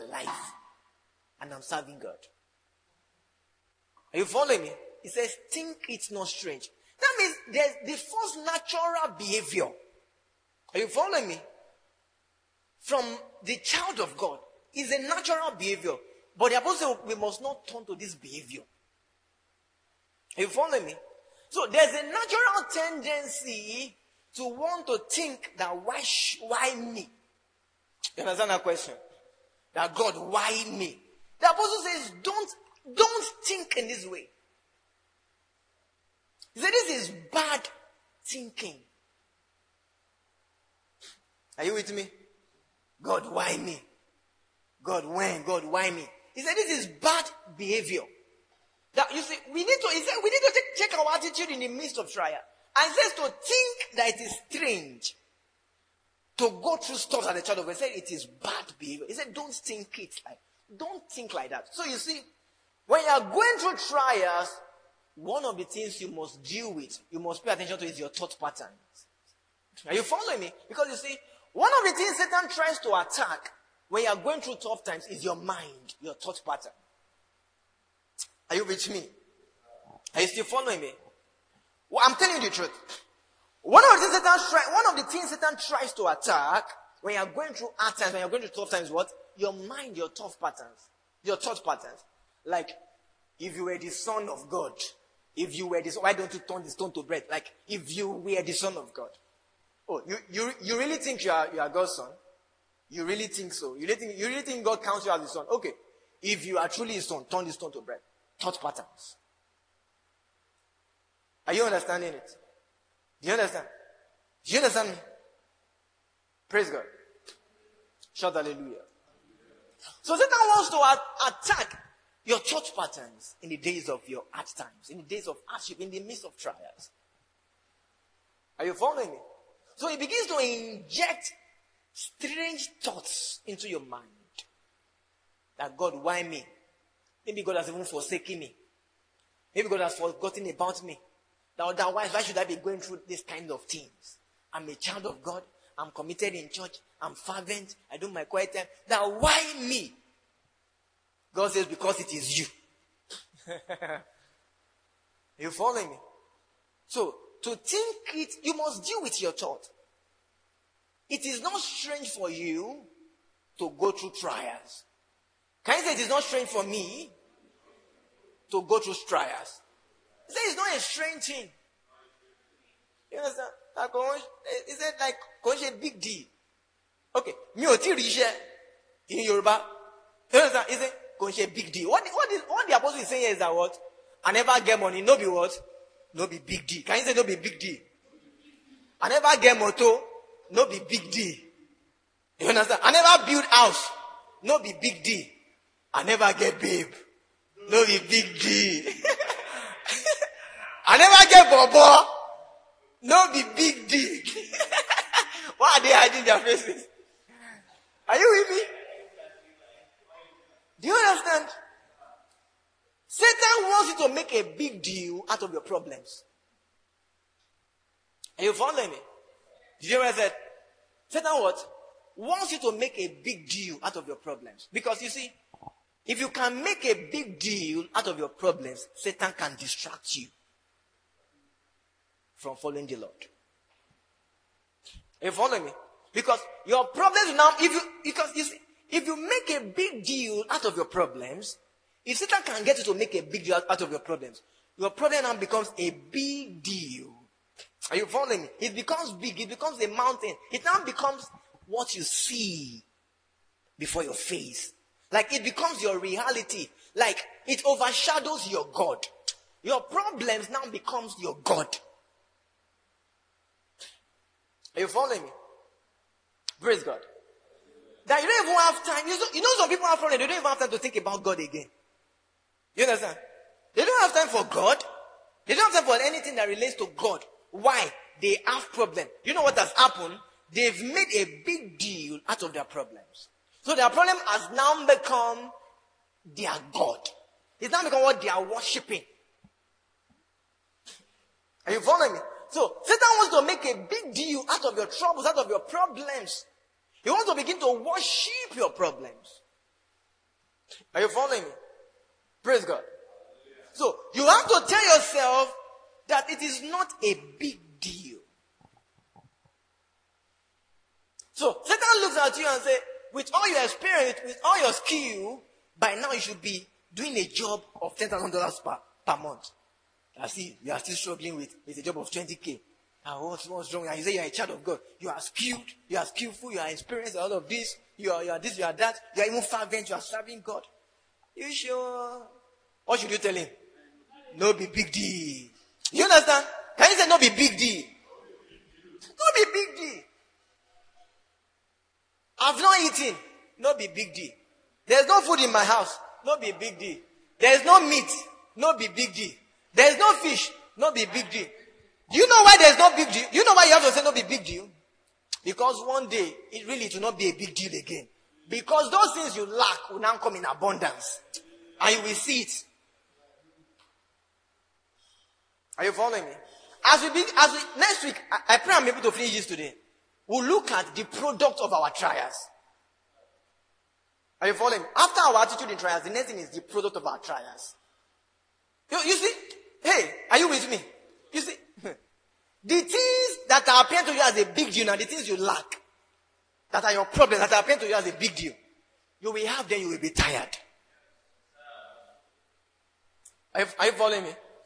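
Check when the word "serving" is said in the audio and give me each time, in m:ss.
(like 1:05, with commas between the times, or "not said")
0:01, 5:30.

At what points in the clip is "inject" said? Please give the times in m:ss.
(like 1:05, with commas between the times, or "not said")
2:10.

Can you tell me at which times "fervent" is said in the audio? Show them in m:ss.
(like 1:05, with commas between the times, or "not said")
2:27, 5:29.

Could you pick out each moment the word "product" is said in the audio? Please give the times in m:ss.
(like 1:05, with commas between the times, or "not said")
6:11, 6:16.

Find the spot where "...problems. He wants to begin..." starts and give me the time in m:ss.
4:55.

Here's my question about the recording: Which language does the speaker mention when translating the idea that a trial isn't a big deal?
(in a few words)
Yoruba.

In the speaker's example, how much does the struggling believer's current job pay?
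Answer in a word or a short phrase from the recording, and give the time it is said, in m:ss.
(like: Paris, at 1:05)
20k, at 5:22.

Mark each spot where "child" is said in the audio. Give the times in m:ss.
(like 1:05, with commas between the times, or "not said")
0:13, 0:57, 2:24, 5:24.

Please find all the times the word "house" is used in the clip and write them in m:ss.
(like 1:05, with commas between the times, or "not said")
3:13, 5:45.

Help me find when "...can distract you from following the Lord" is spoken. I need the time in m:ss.
3:49.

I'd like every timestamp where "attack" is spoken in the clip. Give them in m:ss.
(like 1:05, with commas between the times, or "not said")
1:12, 1:26, 2:01.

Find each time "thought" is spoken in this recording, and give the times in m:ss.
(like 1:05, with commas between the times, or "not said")
1:08, 1:16, 1:31, 1:48, 2:12, 2:39.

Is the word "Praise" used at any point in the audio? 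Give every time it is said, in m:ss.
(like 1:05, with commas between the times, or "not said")
1:56, 4:26, 5:02.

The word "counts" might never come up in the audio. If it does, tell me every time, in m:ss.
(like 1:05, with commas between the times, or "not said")
1:44.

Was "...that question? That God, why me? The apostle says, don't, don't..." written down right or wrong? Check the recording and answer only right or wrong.
right.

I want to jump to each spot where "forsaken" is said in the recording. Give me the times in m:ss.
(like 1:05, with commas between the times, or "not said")
2:17.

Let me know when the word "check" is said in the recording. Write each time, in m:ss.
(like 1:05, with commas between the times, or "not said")
0:50.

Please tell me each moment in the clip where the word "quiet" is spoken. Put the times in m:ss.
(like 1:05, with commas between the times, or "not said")
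2:28.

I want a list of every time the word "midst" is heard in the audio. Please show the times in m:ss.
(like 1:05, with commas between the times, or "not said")
0:51, 2:06.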